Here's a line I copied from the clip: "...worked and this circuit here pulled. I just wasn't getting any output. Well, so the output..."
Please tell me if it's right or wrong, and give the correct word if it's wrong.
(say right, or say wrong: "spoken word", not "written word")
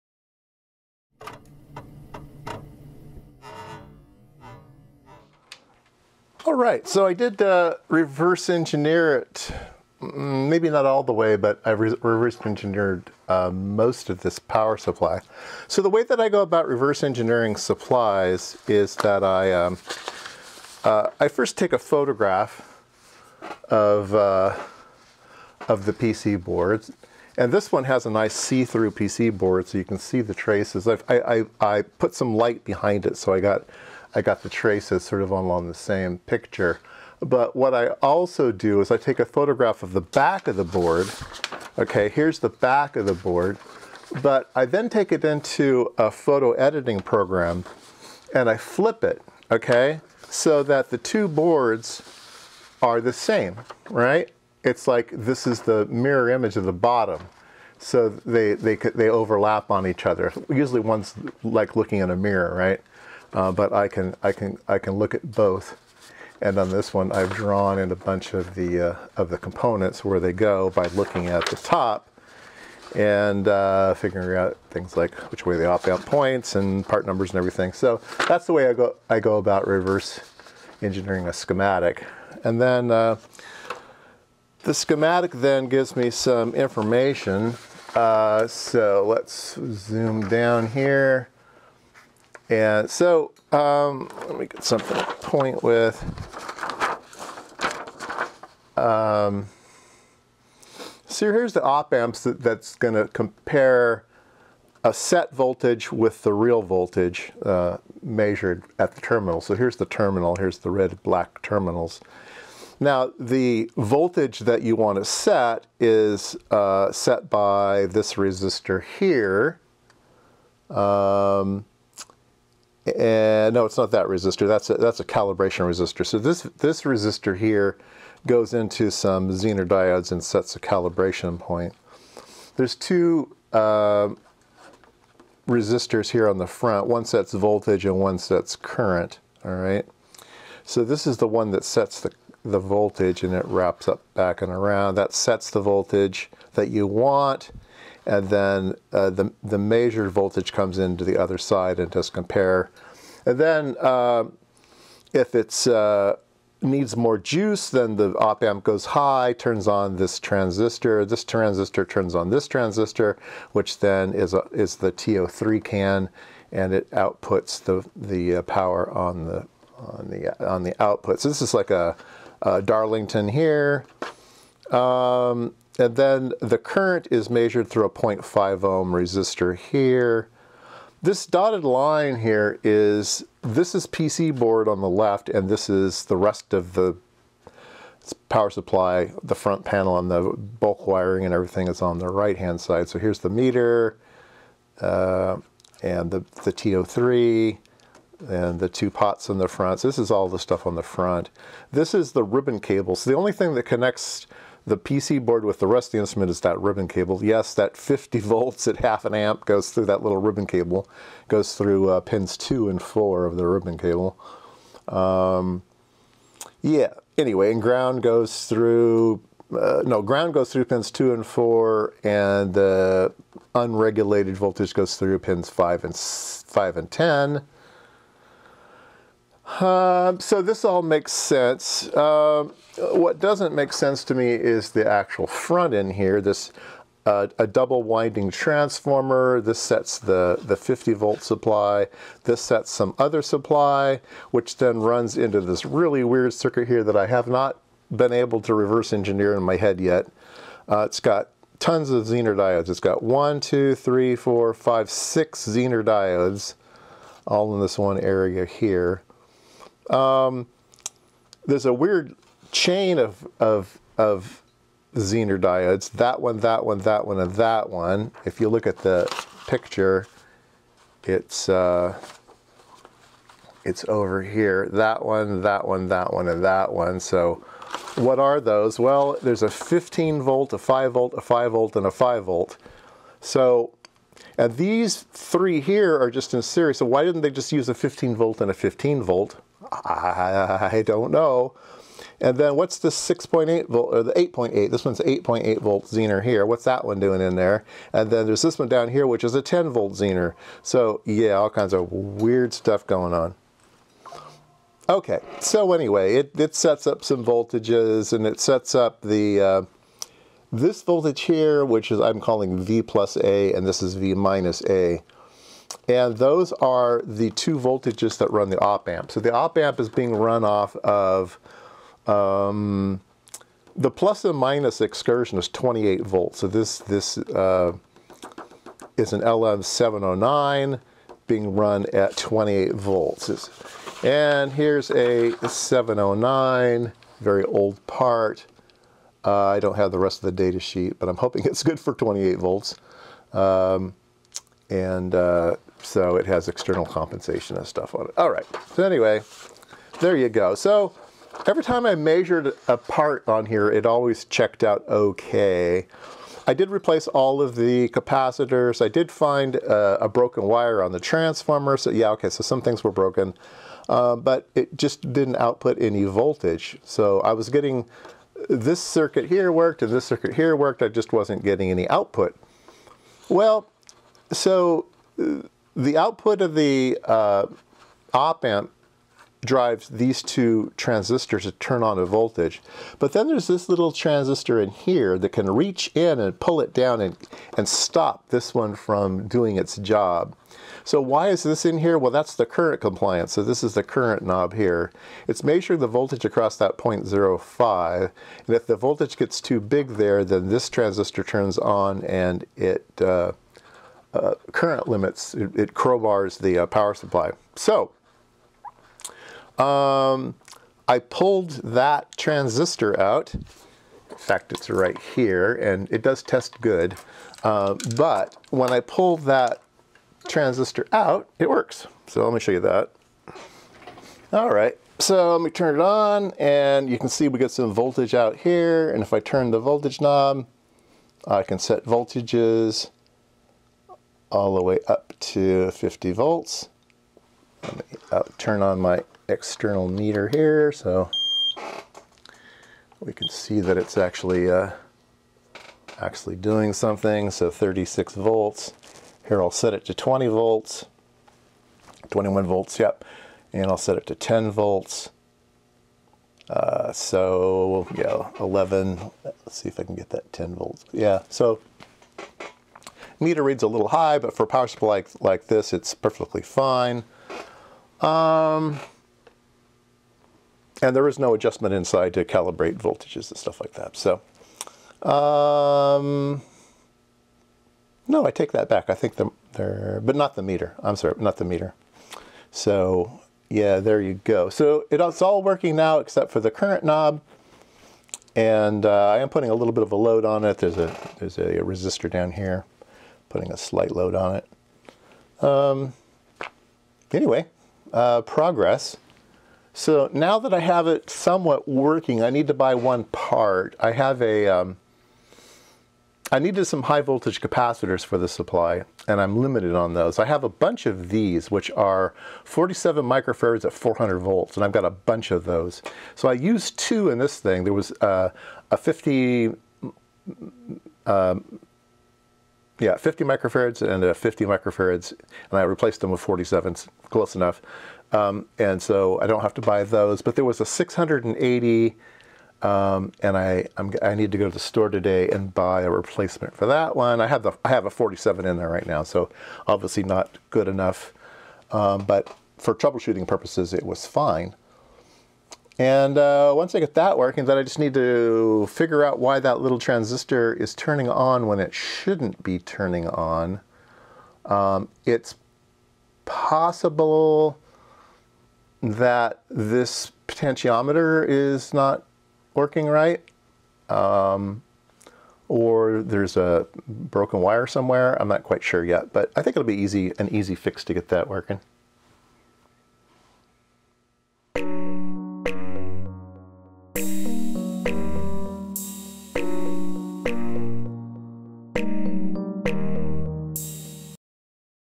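wrong: "worked", not "pulled".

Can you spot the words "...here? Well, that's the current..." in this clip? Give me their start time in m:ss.
6:31.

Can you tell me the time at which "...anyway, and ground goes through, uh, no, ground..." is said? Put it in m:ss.
3:37.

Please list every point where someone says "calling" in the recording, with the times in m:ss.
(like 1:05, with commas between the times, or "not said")
5:12.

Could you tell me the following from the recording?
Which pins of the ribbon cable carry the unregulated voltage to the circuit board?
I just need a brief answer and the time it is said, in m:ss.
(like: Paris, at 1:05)
5 and 10, at 3:45.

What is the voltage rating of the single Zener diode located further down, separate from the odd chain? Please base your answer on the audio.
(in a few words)
10 volts.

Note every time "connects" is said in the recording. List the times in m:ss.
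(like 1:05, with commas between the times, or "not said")
3:23.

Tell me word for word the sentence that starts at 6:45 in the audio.
It, it crowbars the uh, power supply.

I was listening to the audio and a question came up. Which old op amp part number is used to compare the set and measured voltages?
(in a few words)
LM709.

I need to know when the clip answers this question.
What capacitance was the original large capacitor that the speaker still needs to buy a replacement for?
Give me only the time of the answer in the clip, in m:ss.
8:50.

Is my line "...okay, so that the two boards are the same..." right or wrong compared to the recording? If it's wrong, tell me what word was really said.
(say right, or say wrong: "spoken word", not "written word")
right.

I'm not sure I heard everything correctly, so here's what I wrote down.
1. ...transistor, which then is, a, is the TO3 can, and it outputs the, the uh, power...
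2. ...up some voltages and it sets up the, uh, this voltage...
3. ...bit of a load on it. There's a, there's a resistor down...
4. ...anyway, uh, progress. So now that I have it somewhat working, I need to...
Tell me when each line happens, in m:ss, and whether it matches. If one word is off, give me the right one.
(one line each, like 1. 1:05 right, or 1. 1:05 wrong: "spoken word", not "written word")
1. 2:42 right
2. 5:06 right
3. 8:09 right
4. 8:17 right.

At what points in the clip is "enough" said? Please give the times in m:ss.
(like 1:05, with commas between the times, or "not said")
8:47, 9:00.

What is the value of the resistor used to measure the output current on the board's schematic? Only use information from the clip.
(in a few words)
0.5 ohm.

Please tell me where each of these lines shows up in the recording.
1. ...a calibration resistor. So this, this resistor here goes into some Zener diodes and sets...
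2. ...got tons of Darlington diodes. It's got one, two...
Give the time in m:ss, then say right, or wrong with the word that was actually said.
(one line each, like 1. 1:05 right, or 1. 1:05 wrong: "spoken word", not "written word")
1. 2:04 right
2. 4:10 wrong: "Zener", not "Darlington".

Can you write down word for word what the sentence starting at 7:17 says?
Let me uh, turn on my external meter here so we can see that it's actually uh, actually doing something.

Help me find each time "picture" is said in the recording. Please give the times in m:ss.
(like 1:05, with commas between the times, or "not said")
0:36, 4:29.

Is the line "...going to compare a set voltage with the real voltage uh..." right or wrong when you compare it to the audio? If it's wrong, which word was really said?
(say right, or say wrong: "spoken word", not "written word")
right.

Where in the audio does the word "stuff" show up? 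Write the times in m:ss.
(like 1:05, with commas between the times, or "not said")
3:20, 5:02, 5:47, 7:53.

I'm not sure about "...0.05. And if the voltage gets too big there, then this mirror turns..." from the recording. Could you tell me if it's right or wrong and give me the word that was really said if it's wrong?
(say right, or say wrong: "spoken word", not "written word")
wrong: "transistor", not "mirror".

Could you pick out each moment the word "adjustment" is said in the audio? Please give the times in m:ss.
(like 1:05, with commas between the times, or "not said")
7:51.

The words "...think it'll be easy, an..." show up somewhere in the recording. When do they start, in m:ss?
9:29.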